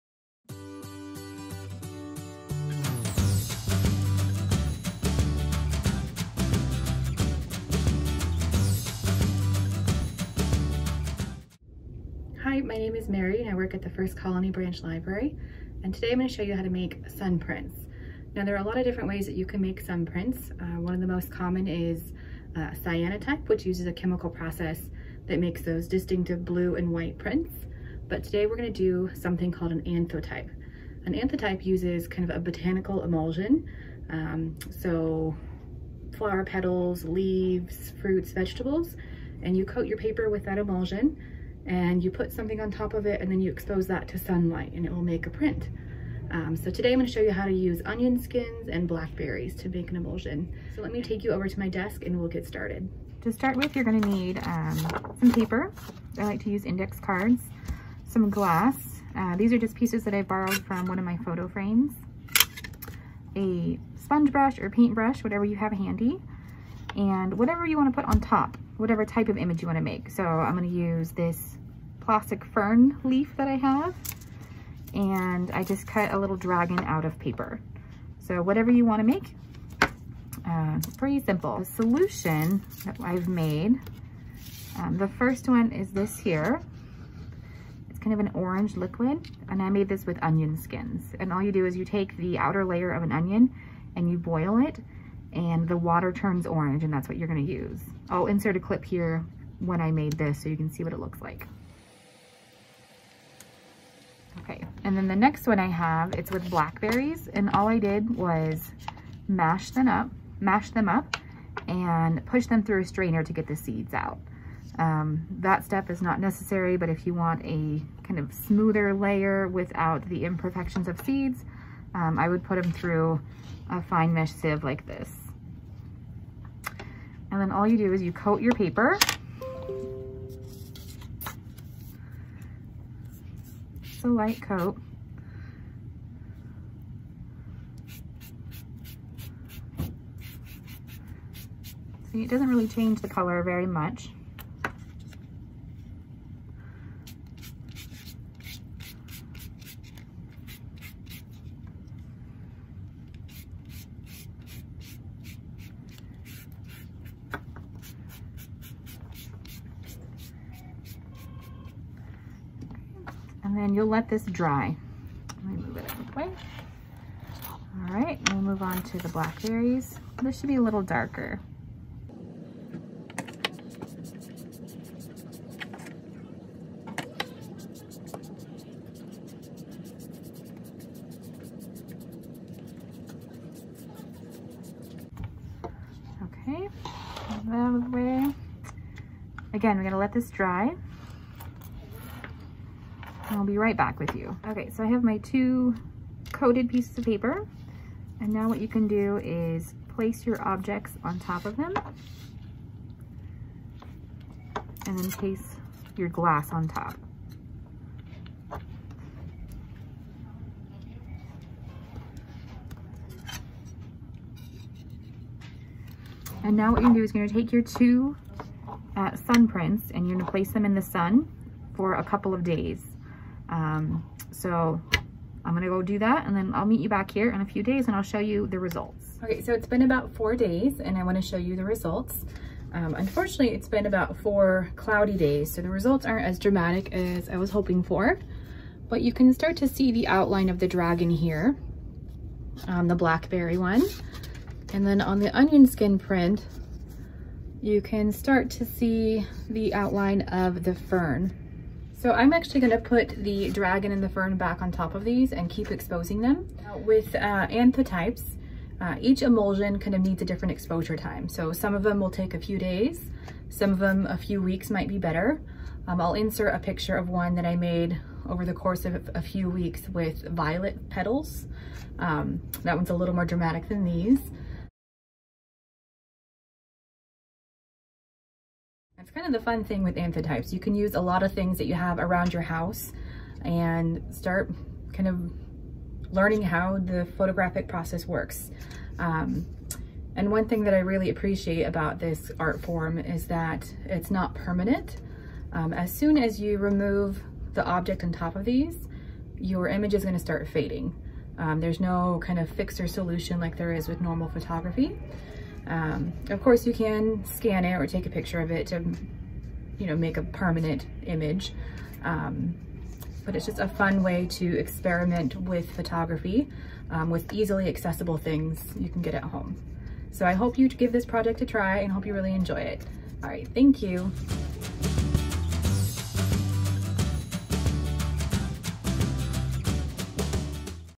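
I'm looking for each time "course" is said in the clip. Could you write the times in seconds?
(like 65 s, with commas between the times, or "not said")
268 s, 306 s.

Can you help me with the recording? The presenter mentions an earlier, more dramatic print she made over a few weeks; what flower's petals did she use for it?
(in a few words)
violet.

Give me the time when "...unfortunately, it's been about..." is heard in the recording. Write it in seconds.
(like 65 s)
232 s.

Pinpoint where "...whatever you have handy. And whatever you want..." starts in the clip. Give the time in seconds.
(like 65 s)
65 s.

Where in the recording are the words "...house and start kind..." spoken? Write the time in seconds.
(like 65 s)
282 s.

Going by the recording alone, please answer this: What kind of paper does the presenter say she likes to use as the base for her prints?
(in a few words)
index cards.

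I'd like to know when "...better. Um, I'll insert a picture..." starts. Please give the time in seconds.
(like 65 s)
264 s.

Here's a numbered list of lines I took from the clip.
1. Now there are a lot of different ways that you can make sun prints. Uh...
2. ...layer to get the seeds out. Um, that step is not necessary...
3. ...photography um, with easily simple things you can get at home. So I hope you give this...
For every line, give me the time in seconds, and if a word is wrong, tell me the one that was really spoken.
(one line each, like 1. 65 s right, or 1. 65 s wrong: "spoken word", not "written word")
1. 18 s right
2. 112 s wrong: "strainer", not "layer"
3. 315 s wrong: "accessible", not "simple".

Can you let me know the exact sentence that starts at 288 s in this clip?
Um, and one thing that I really appreciate about this art form is that it's not permanent.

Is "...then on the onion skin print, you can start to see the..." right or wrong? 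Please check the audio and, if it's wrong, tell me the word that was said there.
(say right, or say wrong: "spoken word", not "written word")
right.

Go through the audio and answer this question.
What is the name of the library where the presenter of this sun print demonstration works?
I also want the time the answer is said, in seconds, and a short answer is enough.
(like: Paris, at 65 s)
First Colony Branch Library, at 13 s.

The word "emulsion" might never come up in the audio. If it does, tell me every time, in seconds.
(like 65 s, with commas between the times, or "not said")
33 s, 40 s, 49 s, 259 s.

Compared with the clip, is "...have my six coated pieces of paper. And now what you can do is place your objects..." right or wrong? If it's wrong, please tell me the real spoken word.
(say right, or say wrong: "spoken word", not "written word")
wrong: "two", not "six".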